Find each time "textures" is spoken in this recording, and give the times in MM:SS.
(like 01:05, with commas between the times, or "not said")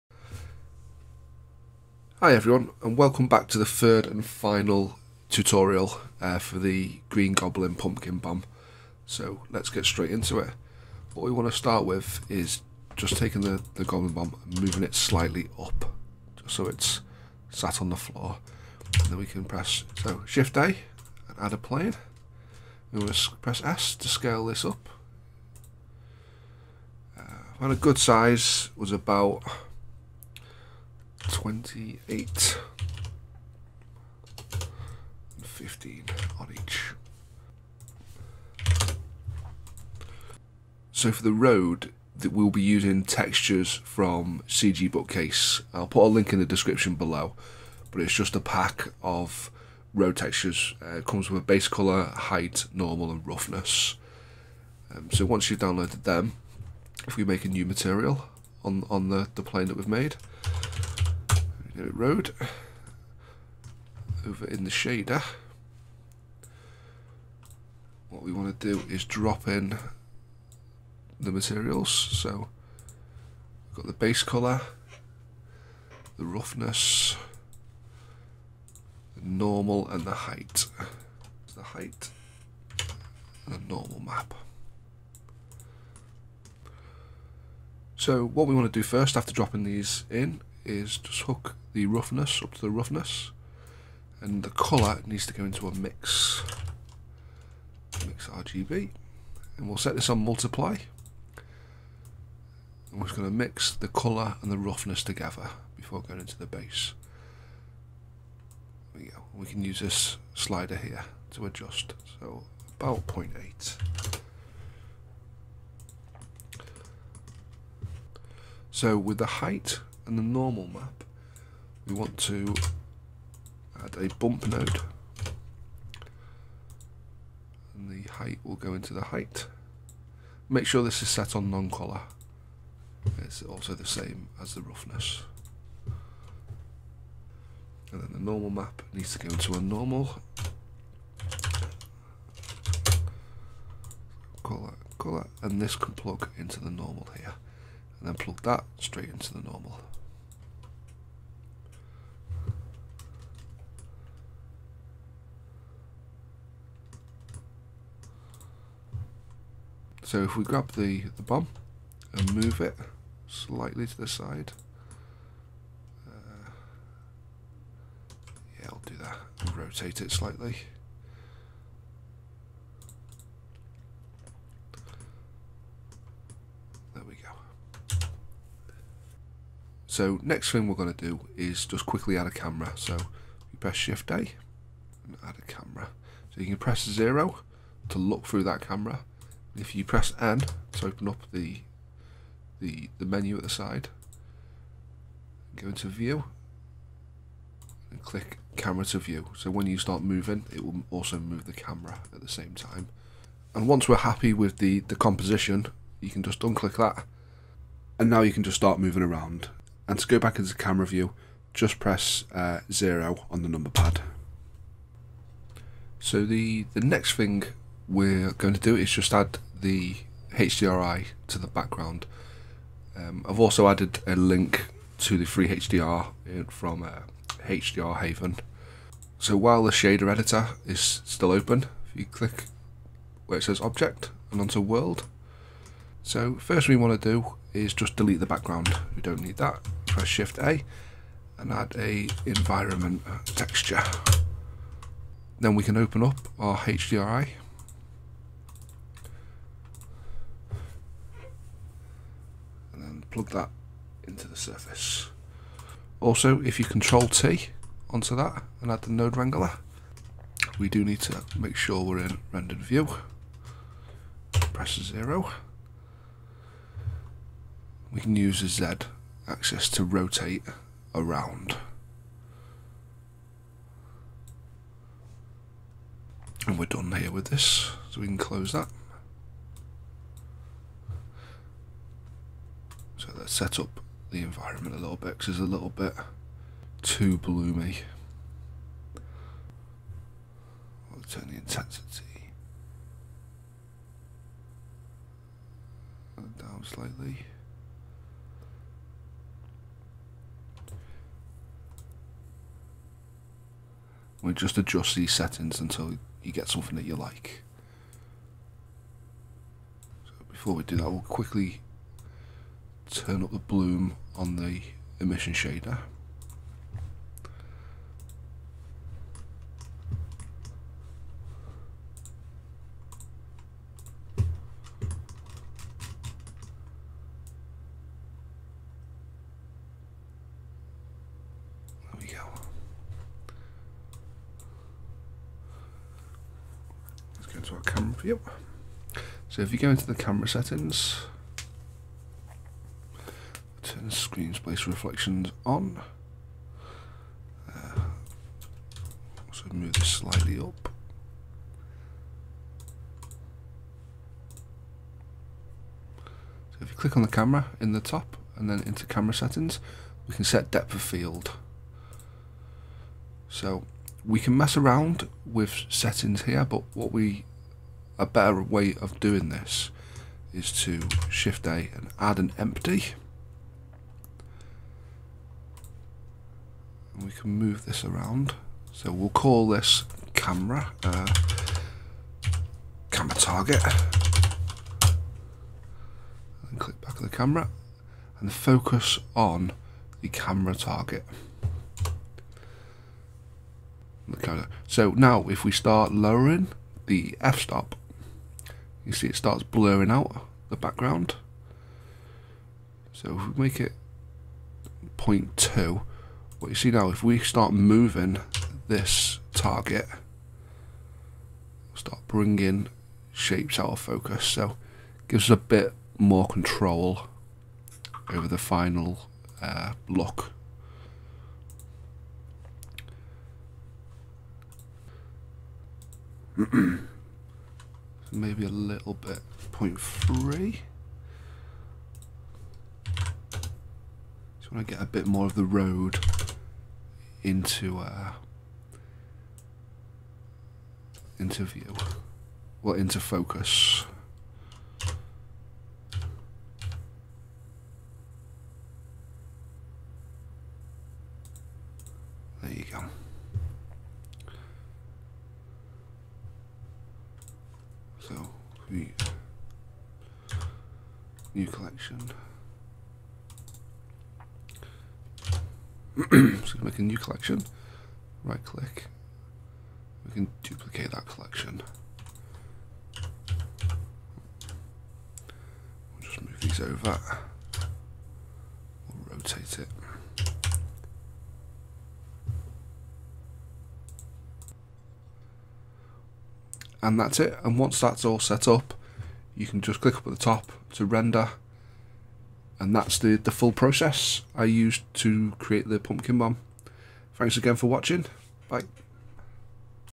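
00:43, 00:50, 04:03.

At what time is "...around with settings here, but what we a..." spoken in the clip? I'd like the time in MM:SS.
06:04.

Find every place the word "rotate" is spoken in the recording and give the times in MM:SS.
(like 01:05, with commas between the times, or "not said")
02:49, 04:29, 07:59.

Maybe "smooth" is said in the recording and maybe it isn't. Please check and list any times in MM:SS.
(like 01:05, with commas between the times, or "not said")
not said.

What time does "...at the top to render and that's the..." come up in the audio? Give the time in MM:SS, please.
08:10.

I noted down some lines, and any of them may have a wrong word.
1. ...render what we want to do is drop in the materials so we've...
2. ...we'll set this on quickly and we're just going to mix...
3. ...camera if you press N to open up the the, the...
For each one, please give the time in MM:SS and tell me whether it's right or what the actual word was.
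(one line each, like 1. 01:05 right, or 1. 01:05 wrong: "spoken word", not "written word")
1. 01:04 wrong: "shader", not "render"
2. 01:39 wrong: "multiply", not "quickly"
3. 03:08 right.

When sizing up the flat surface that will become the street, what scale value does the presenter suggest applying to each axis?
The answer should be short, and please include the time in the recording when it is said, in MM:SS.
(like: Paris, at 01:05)
15, at 00:35.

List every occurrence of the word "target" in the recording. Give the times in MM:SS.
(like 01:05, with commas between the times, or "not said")
06:23, 06:30, 06:49.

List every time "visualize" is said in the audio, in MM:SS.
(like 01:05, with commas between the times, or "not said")
not said.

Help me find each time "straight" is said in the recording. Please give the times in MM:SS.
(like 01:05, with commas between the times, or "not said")
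00:09, 02:28.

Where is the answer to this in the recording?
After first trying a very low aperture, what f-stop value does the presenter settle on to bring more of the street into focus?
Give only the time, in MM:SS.
07:09.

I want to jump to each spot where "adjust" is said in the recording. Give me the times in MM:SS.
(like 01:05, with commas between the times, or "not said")
01:51, 05:04.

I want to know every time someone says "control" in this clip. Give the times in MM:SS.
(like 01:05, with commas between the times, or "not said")
04:16, 06:56.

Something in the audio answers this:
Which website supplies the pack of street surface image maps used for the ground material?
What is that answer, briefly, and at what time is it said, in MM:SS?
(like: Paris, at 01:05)
CG Bookcase, at 00:44.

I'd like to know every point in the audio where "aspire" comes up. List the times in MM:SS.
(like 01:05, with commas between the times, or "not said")
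not said.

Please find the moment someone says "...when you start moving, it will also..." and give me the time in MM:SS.
03:19.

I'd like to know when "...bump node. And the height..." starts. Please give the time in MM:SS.
02:04.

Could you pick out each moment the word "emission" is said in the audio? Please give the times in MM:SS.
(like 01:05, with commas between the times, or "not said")
05:14.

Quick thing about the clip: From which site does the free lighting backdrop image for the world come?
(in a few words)
HDR Haven.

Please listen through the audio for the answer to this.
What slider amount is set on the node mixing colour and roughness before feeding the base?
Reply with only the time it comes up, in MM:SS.
01:53.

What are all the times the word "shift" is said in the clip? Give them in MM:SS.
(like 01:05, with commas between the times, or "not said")
00:20, 03:03, 04:00, 06:11.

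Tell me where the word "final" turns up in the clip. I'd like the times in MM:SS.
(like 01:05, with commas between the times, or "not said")
00:04, 06:58.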